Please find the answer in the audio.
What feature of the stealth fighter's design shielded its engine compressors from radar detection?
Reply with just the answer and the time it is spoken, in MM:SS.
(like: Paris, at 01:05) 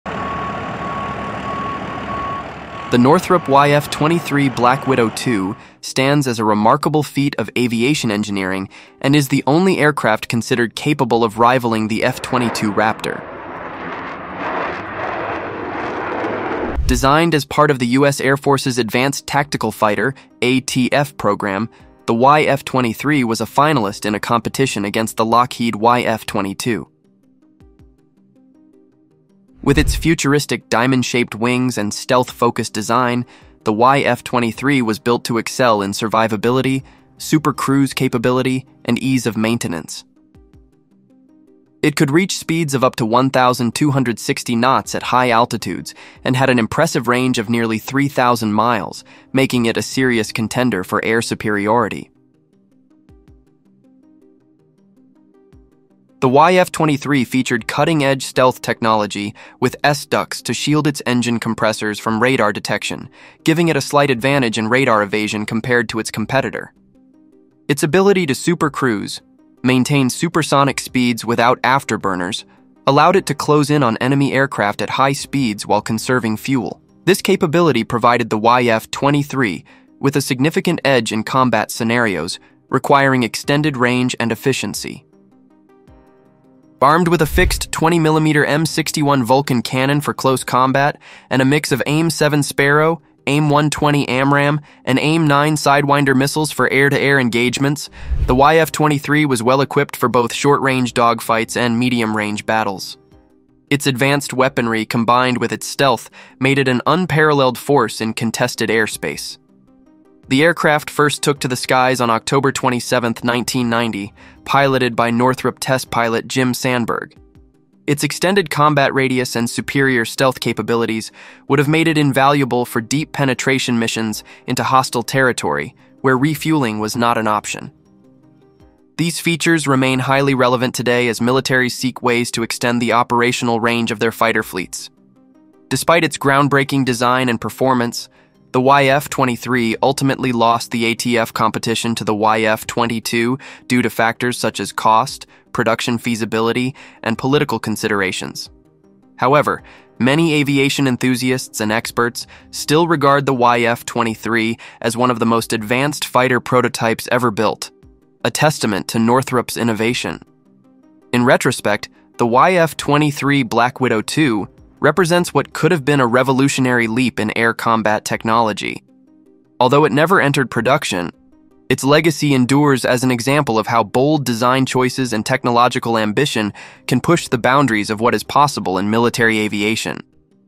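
S-ducts, at 00:59.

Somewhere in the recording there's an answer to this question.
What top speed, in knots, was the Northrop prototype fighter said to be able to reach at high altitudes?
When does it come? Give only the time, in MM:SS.
00:43.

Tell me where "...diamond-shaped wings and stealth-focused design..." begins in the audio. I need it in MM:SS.
00:30.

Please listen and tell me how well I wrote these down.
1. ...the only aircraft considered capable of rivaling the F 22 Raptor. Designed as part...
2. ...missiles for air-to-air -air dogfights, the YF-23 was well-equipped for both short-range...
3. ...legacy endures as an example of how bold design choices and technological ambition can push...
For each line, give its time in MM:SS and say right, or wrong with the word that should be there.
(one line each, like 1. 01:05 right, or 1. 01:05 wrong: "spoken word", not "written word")
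1. 00:09 right
2. 01:36 wrong: "engagements", not "dogfights"
3. 02:51 right.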